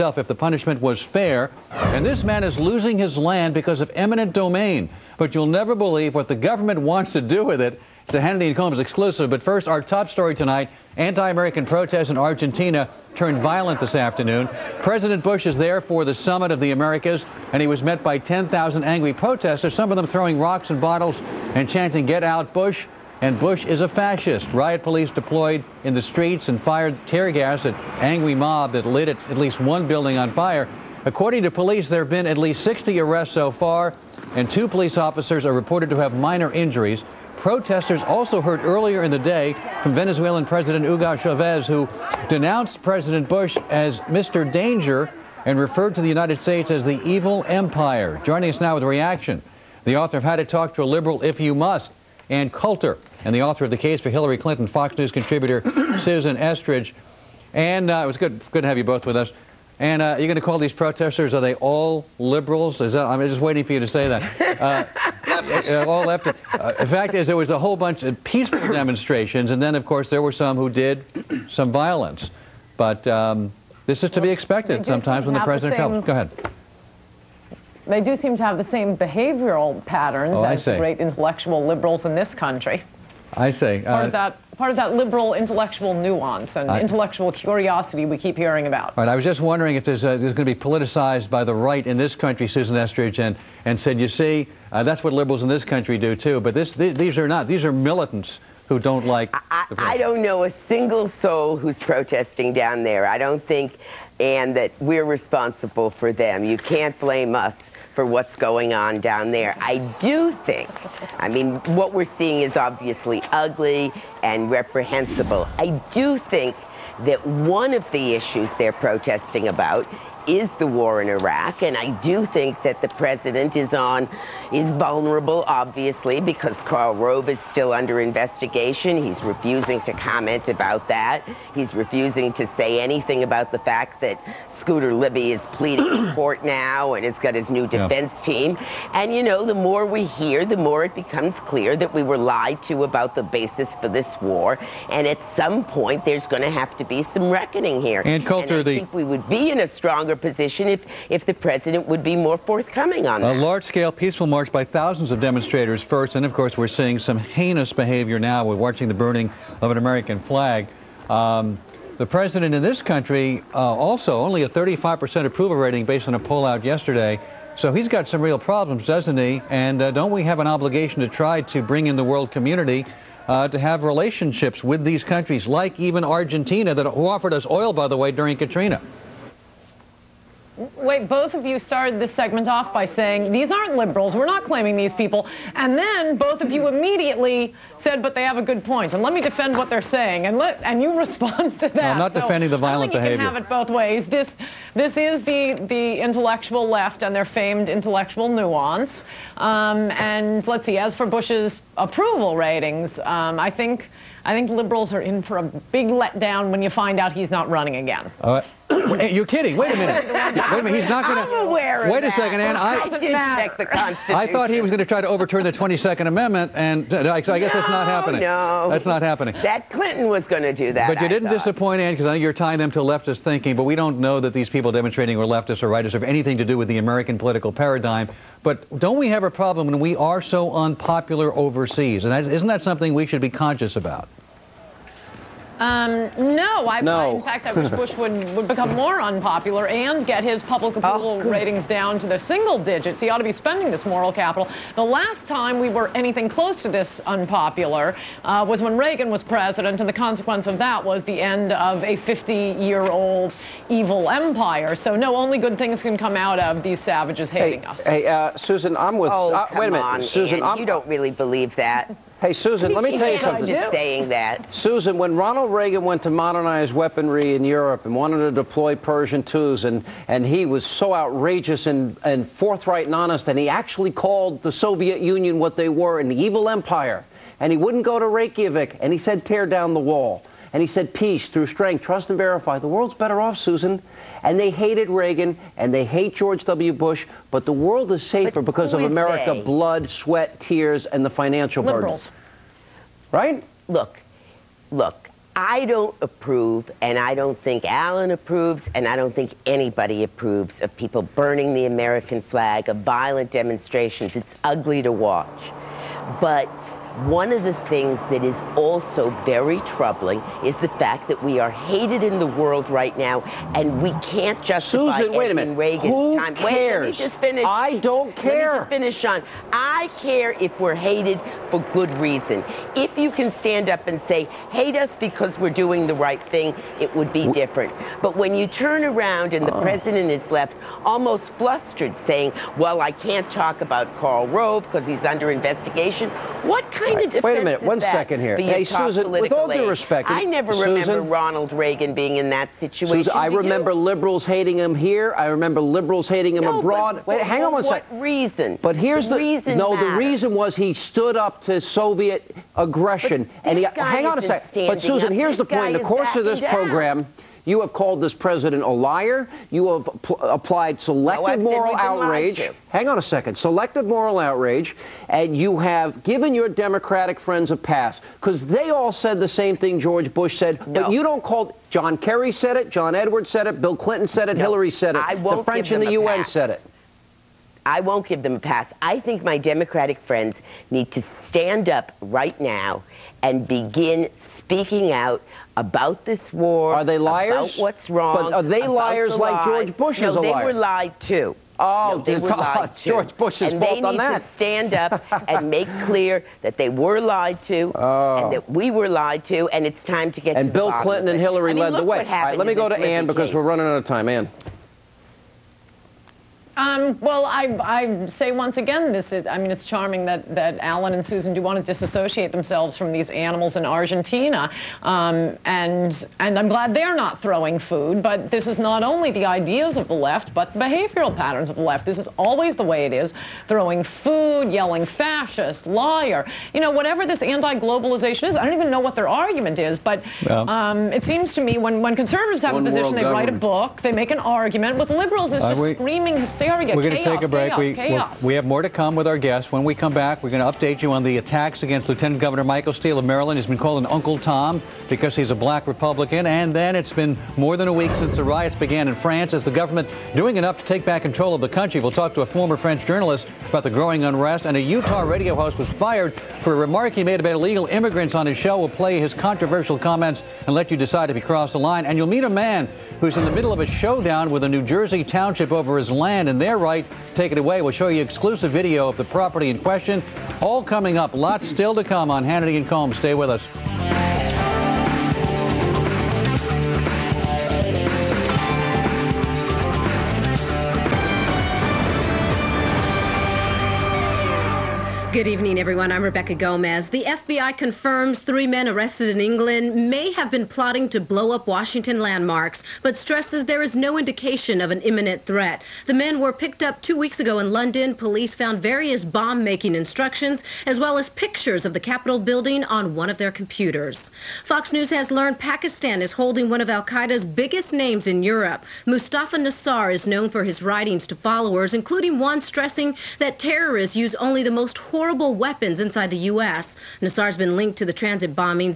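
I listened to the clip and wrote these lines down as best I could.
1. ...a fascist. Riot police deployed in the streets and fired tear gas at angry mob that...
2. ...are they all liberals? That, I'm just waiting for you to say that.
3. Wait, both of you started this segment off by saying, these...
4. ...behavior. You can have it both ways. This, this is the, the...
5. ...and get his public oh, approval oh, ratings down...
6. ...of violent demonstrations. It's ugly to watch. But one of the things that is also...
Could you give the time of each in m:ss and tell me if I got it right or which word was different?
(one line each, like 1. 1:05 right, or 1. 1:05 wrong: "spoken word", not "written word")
1. 0:23 right
2. 1:01 right
3. 3:00 right
4. 3:12 right
5. 3:59 right
6. 5:02 right.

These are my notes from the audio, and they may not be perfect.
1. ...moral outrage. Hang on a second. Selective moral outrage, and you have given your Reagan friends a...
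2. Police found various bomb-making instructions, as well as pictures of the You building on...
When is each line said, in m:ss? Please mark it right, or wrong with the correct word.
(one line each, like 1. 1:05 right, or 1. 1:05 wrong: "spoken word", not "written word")
1. 6:01 wrong: "Democratic", not "Reagan"
2. 8:17 wrong: "Capitol", not "You".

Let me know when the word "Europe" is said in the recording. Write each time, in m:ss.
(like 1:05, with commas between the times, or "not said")
4:27, 8:28.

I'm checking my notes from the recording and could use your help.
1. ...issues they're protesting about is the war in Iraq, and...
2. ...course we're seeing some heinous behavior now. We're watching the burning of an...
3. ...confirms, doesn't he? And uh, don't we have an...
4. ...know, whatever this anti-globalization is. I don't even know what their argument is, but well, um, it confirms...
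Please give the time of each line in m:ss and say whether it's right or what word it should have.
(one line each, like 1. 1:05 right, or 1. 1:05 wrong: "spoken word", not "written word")
1. 1:58 right
2. 2:36 right
3. 2:48 wrong: "problems", not "confirms"
4. 7:06 wrong: "seems", not "confirms".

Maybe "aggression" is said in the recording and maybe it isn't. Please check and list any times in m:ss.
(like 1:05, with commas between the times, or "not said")
5:52.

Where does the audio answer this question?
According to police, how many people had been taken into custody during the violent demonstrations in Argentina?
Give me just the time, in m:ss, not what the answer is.
0:32.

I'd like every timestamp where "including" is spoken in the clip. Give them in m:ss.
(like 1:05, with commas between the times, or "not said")
8:31.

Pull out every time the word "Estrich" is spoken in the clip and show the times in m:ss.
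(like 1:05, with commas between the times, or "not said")
0:56, 1:32.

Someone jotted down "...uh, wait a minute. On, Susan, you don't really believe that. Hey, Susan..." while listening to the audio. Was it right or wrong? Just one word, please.
right.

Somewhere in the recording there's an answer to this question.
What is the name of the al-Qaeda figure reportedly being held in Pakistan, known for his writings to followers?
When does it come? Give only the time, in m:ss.
8:28.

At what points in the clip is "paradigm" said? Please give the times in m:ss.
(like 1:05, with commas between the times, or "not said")
3:47.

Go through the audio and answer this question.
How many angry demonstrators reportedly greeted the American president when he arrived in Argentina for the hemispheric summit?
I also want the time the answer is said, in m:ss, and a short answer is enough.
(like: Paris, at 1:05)
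10,000, at 0:18.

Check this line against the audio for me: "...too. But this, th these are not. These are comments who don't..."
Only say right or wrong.
wrong.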